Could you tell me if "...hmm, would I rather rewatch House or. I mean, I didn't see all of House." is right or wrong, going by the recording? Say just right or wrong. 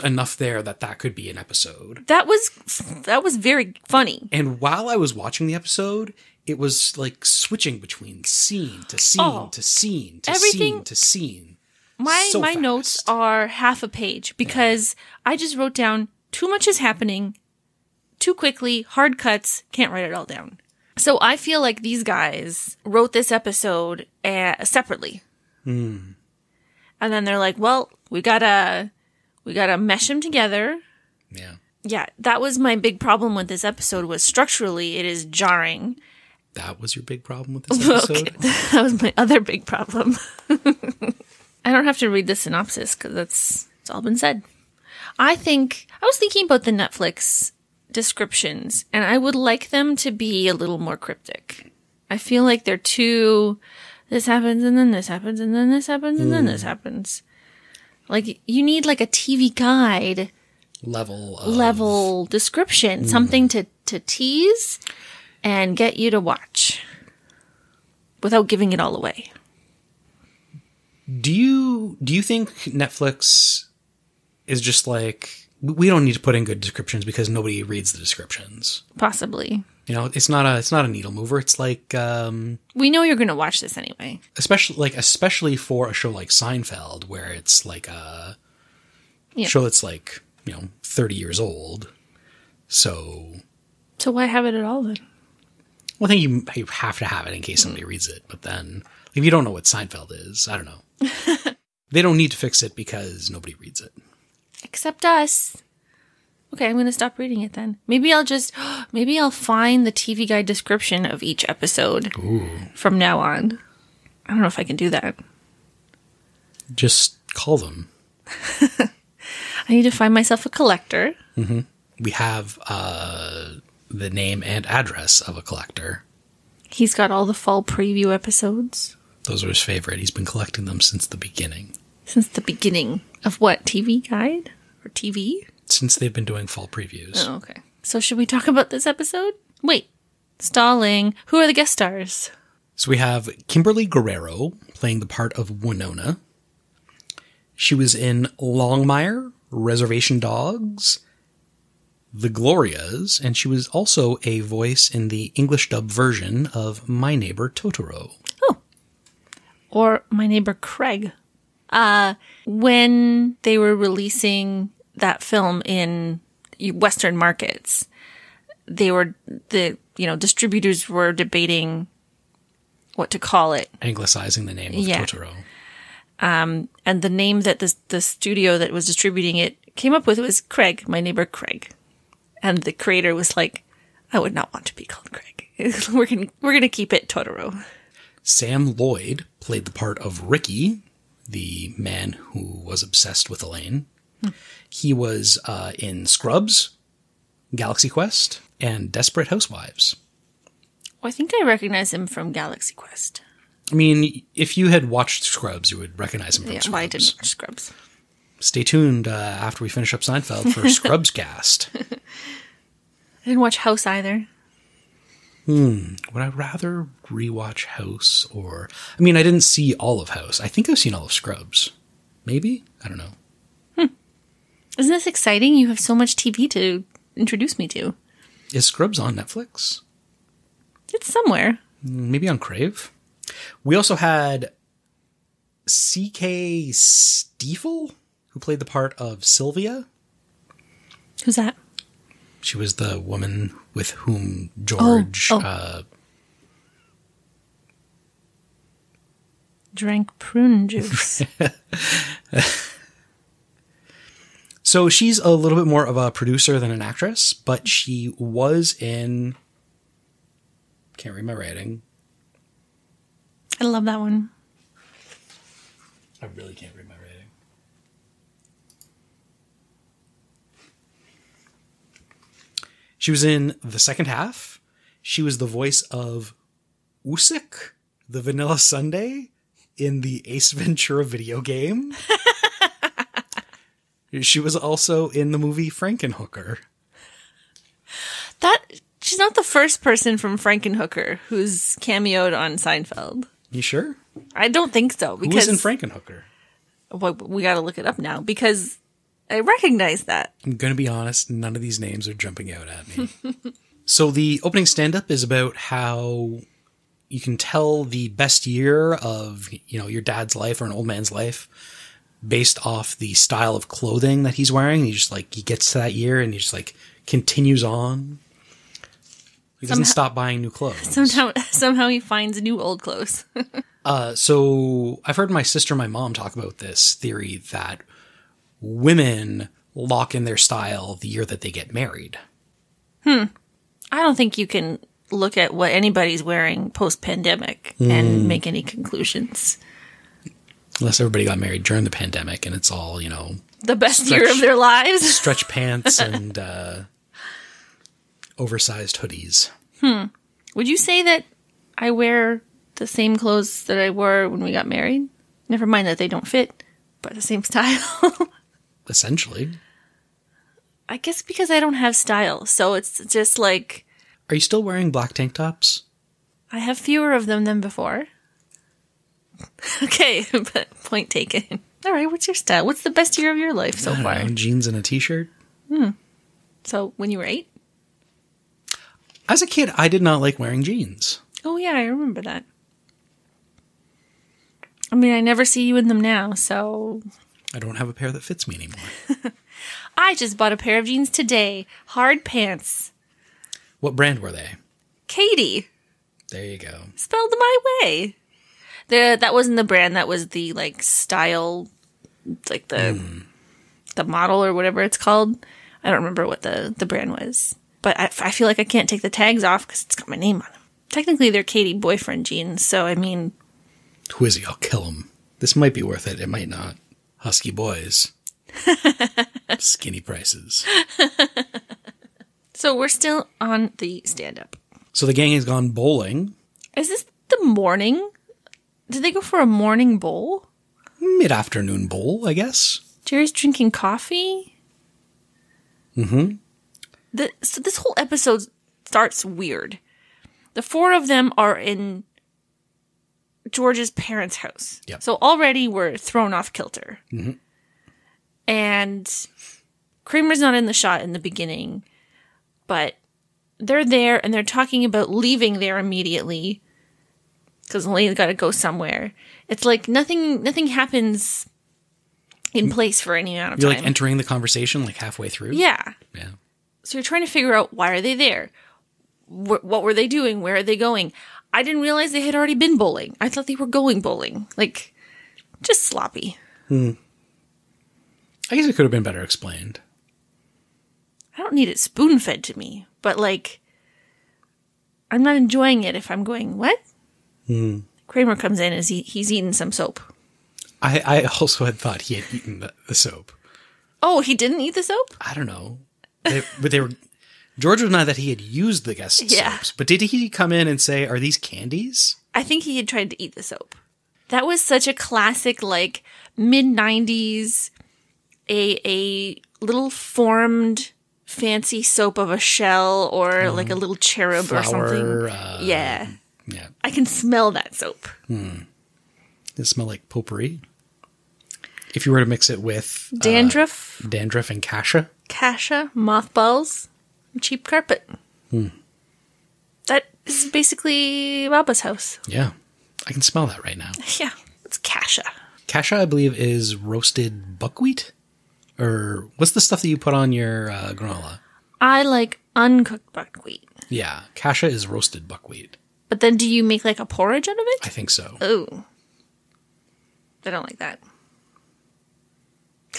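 right.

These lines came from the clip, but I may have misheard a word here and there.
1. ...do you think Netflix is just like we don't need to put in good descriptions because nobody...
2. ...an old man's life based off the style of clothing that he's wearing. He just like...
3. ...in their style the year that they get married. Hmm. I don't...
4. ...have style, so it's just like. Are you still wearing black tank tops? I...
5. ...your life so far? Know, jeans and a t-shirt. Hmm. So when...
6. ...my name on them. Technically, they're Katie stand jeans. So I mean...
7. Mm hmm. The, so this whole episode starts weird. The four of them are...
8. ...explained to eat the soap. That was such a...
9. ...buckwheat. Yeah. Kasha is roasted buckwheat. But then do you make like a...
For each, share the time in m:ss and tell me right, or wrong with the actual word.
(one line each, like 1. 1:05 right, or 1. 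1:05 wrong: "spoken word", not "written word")
1. 1:12 right
2. 5:10 right
3. 5:30 right
4. 6:01 right
5. 6:13 right
6. 6:50 wrong: "boyfriend", not "stand"
7. 7:15 right
8. 8:22 wrong: "tried", not "explained"
9. 9:03 right.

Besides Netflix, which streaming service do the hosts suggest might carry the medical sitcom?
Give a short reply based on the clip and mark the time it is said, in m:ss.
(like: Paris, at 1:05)
Crave, at 3:52.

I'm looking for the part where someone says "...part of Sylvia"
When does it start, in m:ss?
3:58.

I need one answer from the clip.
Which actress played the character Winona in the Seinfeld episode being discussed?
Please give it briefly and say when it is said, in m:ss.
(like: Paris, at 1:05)
Kimberly Guerrero, at 2:23.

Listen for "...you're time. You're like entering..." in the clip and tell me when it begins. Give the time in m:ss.
7:43.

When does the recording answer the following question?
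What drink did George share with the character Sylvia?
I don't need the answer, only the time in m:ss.
4:10.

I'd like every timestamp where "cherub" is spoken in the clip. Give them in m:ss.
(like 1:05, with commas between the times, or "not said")
8:33.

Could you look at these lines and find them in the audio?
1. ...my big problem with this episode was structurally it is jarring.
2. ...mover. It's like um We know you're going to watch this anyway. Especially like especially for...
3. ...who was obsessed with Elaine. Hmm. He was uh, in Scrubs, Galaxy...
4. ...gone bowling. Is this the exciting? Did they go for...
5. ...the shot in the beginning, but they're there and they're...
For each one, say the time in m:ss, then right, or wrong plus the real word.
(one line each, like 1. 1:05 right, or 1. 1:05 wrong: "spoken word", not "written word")
1. 0:32 right
2. 1:21 right
3. 3:12 right
4. 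7:05 wrong: "morning", not "exciting"
5. 7:30 right.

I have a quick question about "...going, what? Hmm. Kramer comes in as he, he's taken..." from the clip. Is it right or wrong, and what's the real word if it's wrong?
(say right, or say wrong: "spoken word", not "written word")
wrong: "eaten", not "taken".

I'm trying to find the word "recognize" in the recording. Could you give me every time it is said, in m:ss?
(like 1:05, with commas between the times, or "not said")
3:21, 3:25, 4:59.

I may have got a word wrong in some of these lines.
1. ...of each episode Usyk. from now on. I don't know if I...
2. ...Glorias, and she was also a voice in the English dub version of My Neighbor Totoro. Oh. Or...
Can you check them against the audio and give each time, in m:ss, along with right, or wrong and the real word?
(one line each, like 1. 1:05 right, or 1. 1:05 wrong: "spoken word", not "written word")
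1. 1:51 wrong: "Ooh", not "Usyk"
2. 2:32 right.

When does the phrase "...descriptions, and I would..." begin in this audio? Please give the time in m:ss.
0:47.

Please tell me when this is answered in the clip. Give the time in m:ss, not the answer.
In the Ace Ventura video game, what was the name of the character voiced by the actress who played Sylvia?
4:37.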